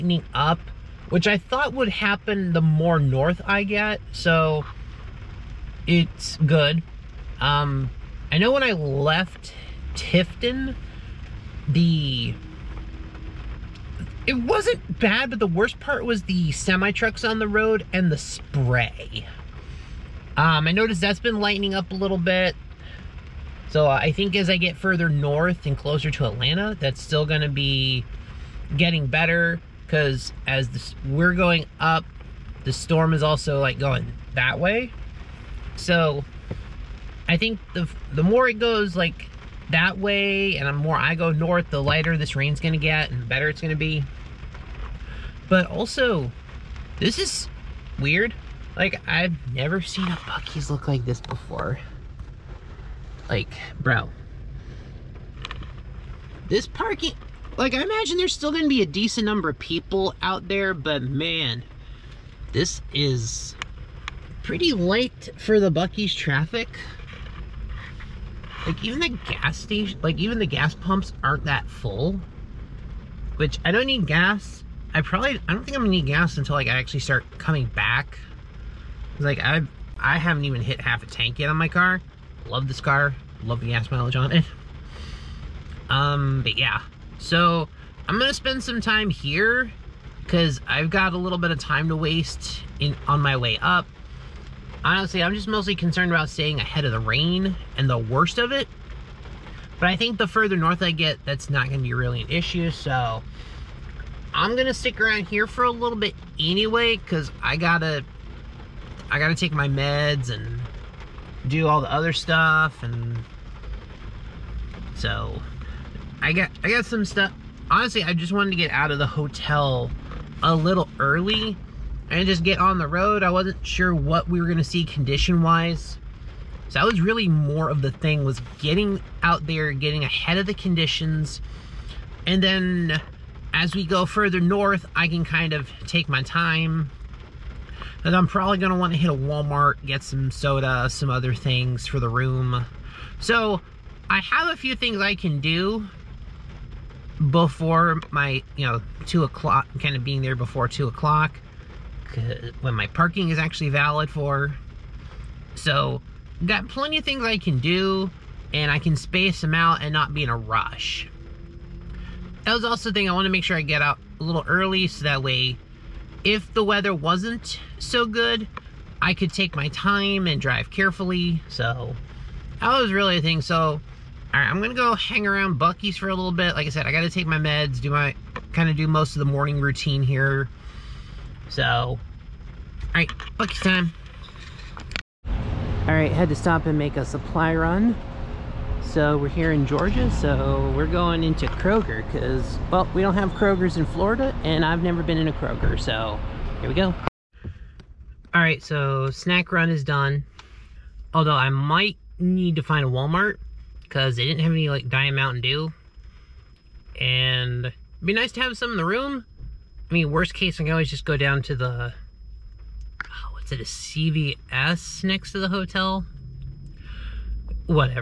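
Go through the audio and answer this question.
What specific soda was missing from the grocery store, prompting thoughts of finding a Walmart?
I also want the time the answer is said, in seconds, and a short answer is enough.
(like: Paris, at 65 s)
Diet Mountain Dew, at 204 s.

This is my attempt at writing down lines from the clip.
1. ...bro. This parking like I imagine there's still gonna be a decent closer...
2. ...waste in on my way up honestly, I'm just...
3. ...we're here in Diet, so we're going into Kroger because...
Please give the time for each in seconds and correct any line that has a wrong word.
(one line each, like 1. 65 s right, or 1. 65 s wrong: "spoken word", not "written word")
1. 53 s wrong: "number", not "closer"
2. 91 s right
3. 189 s wrong: "Georgia", not "Diet".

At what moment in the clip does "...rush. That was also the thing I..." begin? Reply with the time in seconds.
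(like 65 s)
160 s.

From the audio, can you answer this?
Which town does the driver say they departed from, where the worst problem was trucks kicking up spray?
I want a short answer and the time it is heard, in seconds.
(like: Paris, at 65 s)
Tifton, at 9 s.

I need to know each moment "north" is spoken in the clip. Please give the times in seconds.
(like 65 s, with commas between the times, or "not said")
2 s, 25 s, 41 s, 100 s, 134 s.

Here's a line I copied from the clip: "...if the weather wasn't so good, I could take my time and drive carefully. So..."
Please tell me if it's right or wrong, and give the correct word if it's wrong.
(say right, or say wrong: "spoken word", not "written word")
right.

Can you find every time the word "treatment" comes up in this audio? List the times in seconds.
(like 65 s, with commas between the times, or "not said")
not said.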